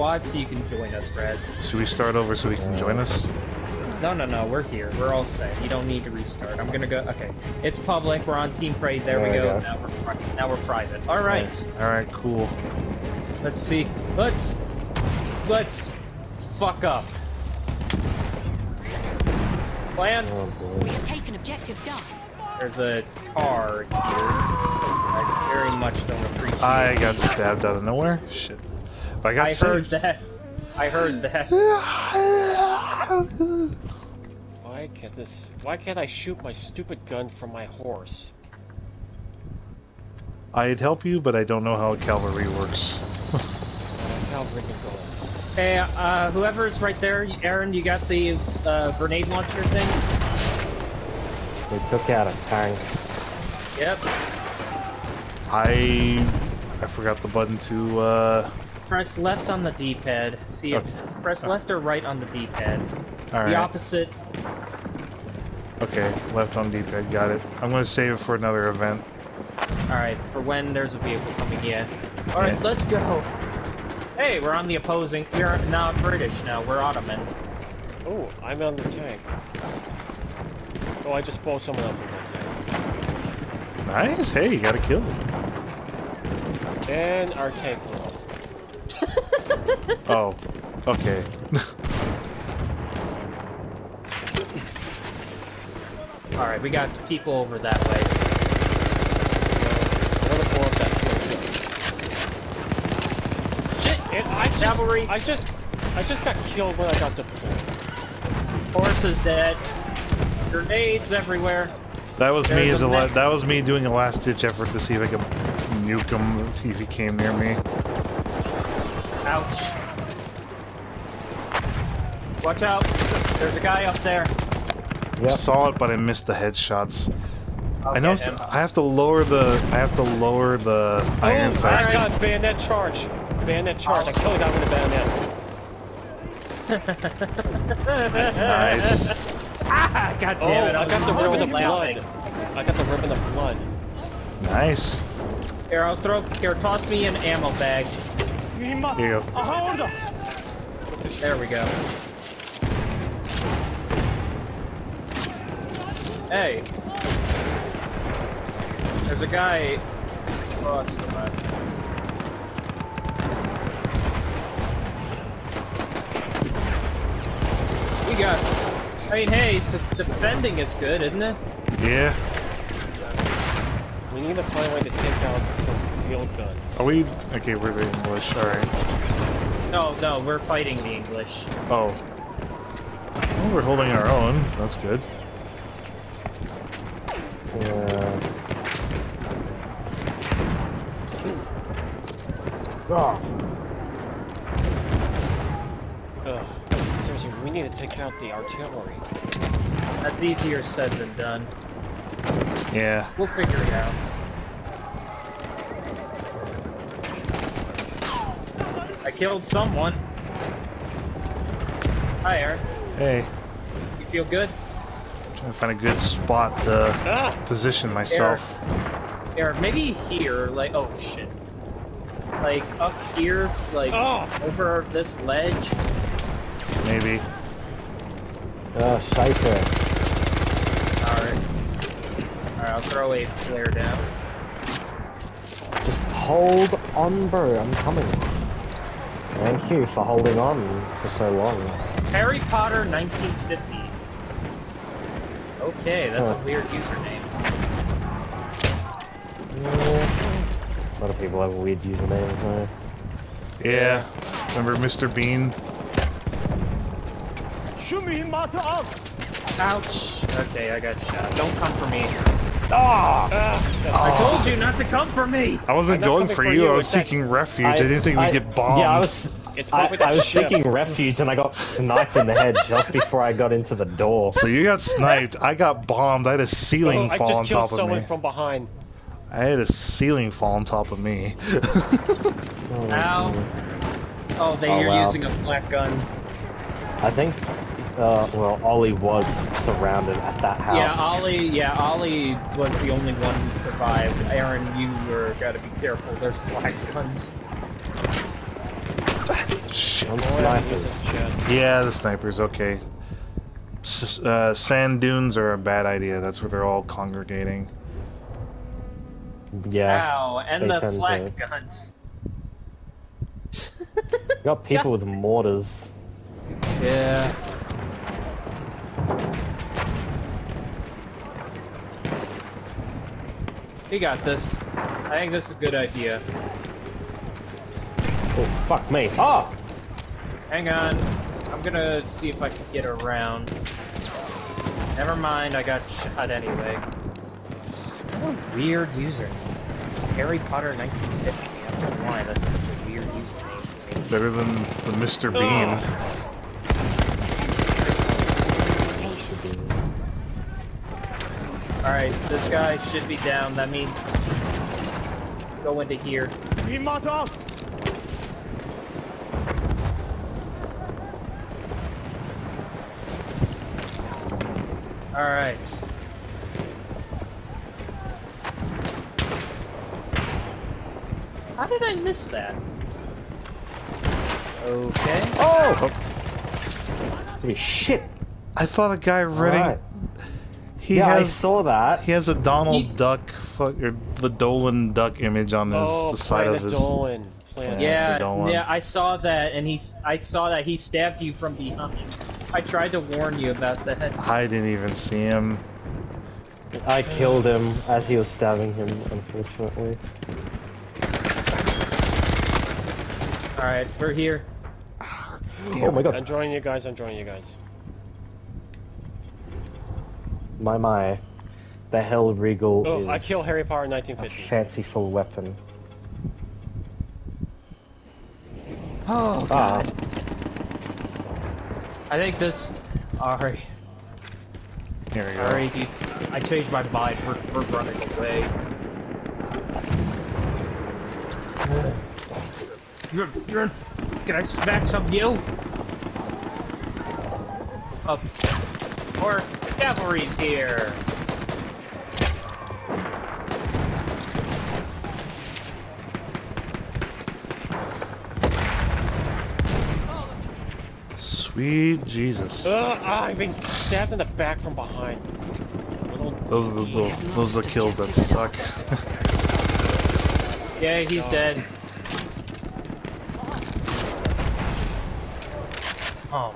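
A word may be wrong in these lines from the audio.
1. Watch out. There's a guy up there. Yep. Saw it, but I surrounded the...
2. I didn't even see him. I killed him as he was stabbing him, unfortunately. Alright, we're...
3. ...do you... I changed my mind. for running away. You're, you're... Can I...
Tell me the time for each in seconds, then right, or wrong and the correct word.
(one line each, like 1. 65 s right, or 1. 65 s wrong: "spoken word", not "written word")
1. 122 s wrong: "missed", not "surrounded"
2. 394 s right
3. 425 s right.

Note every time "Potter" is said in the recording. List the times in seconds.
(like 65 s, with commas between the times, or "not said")
242 s, 340 s, 413 s.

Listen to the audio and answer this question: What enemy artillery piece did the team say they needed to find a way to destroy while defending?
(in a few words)
Field gun.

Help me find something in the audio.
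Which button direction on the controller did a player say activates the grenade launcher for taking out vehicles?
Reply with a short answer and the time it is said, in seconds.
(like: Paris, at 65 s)
Left on the D-pad, at 58 s.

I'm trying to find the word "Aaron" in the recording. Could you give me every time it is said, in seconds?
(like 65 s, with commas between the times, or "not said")
47 s, 294 s.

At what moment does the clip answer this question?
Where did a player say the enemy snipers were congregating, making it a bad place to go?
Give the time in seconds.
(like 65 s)
304 s.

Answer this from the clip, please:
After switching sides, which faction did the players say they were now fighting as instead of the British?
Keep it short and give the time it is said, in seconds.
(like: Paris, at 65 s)
Ottoman, at 76 s.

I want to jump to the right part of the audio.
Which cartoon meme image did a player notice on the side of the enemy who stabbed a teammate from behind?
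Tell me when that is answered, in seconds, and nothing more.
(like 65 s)
384 s.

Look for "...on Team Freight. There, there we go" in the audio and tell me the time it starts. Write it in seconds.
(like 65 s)
8 s.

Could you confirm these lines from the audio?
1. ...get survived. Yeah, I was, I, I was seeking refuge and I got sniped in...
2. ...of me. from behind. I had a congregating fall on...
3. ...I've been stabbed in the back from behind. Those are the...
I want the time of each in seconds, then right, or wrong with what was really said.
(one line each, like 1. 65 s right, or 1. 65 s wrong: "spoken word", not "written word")
1. 268 s wrong: "bombed", not "survived"
2. 277 s wrong: "ceiling", not "congregating"
3. 453 s right.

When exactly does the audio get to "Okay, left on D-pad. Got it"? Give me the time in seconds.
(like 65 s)
65 s.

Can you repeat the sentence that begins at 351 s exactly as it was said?
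Alright, this guy should be down.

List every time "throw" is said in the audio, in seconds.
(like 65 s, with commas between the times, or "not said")
145 s, 232 s.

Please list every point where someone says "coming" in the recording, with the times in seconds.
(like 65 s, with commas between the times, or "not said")
71 s, 237 s.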